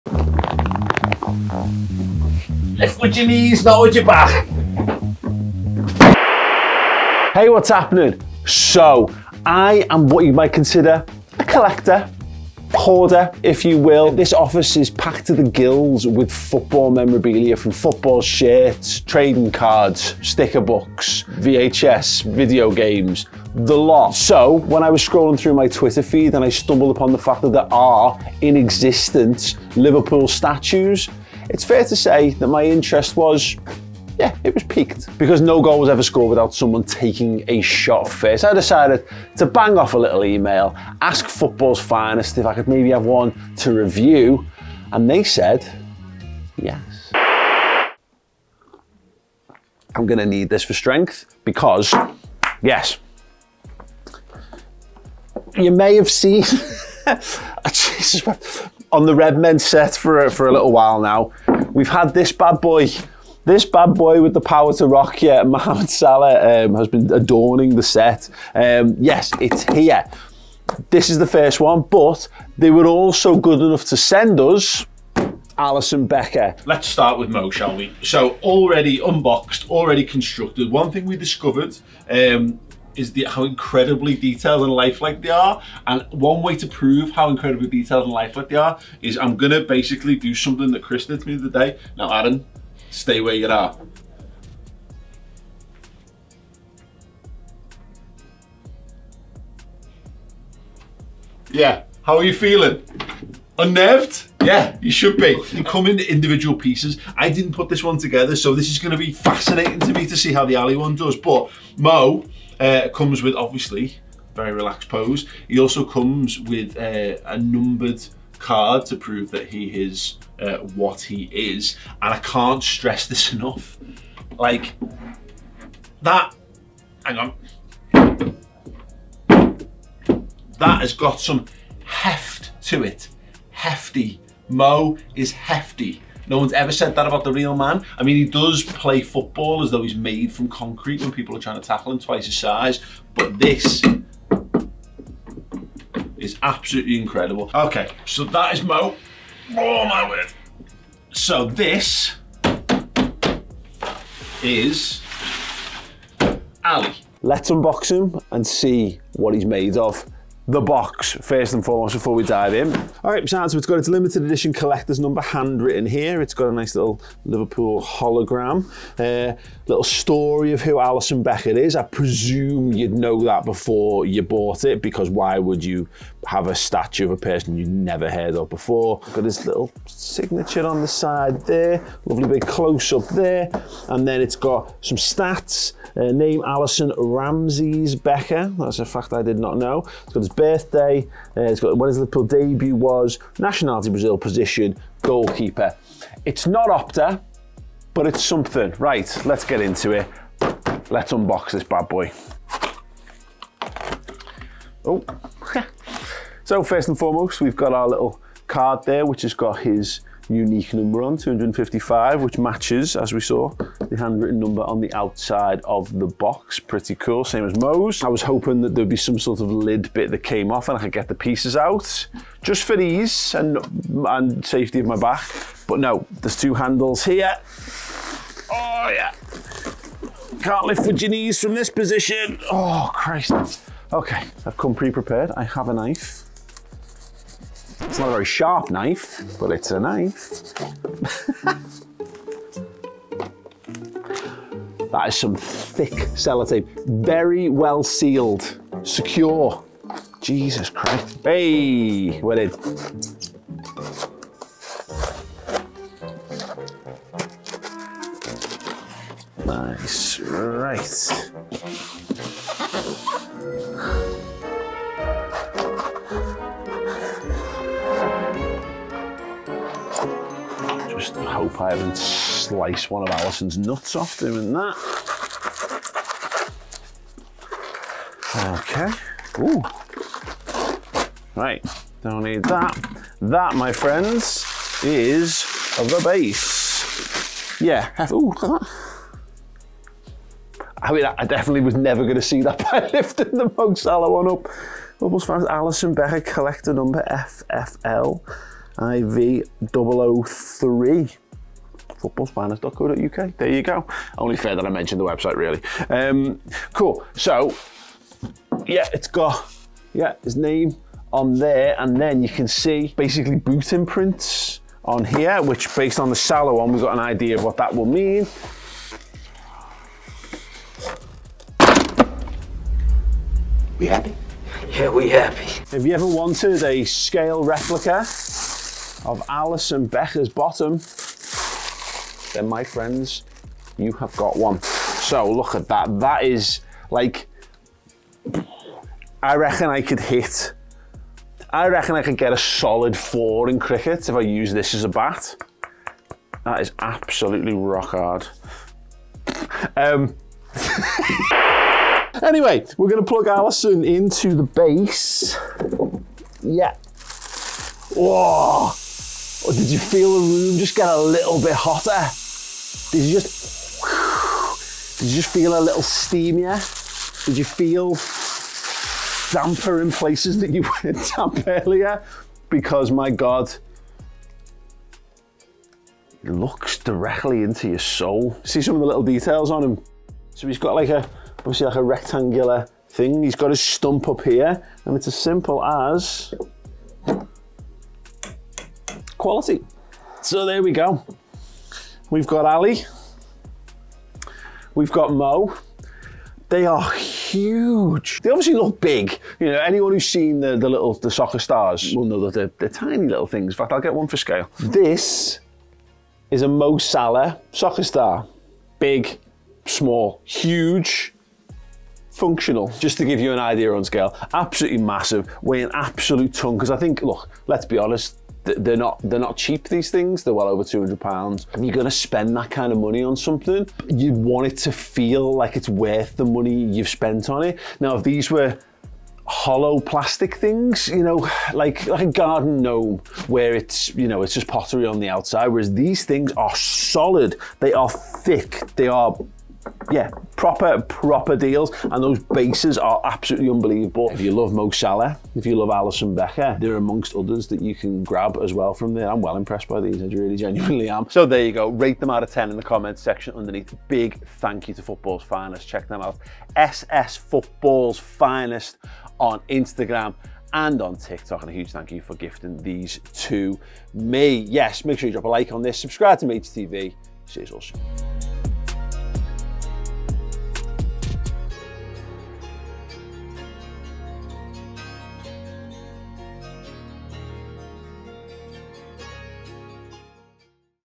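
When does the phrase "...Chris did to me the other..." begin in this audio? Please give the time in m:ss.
1:30.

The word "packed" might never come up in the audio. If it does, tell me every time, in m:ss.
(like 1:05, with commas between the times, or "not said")
0:14.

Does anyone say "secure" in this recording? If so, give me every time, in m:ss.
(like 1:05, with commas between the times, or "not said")
4:08.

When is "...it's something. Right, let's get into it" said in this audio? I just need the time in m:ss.
3:18.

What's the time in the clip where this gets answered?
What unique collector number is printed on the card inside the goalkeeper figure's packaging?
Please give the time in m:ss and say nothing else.
3:31.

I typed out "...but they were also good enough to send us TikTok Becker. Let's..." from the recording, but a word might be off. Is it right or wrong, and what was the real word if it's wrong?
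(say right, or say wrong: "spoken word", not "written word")
wrong: "Alisson", not "TikTok".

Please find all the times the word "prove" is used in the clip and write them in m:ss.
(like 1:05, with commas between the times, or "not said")
1:26, 1:58.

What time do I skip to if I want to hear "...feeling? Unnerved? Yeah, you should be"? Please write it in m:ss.
1:42.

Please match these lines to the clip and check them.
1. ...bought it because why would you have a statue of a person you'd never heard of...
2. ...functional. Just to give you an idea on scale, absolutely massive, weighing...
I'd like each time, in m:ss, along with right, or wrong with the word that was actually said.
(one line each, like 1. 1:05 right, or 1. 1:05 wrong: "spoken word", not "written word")
1. 2:54 right
2. 6:52 right.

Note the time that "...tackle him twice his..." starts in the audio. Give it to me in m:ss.
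2:21.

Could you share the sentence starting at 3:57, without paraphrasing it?
It's not a very sharp knife, but it's a knife.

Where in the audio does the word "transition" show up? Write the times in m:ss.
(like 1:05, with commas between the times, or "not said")
not said.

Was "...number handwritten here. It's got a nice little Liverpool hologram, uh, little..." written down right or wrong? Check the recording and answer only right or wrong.
right.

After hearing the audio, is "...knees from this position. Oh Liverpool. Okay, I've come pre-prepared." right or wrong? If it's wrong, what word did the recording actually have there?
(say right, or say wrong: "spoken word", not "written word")
wrong: "Christ", not "Liverpool".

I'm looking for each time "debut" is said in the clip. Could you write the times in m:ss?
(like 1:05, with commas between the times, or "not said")
3:12.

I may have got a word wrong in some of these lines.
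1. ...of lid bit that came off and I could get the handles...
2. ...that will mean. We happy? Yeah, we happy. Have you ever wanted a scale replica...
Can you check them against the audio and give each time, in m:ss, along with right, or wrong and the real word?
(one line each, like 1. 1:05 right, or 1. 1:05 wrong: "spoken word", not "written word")
1. 3:39 wrong: "pieces", not "handles"
2. 5:17 right.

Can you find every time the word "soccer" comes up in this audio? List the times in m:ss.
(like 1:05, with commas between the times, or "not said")
6:41, 6:47.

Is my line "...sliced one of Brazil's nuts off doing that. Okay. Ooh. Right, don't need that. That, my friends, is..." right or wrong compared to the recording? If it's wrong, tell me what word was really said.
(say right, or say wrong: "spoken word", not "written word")
wrong: "Alisson", not "Brazil".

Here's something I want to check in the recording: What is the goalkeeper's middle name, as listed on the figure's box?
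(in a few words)
Ramses.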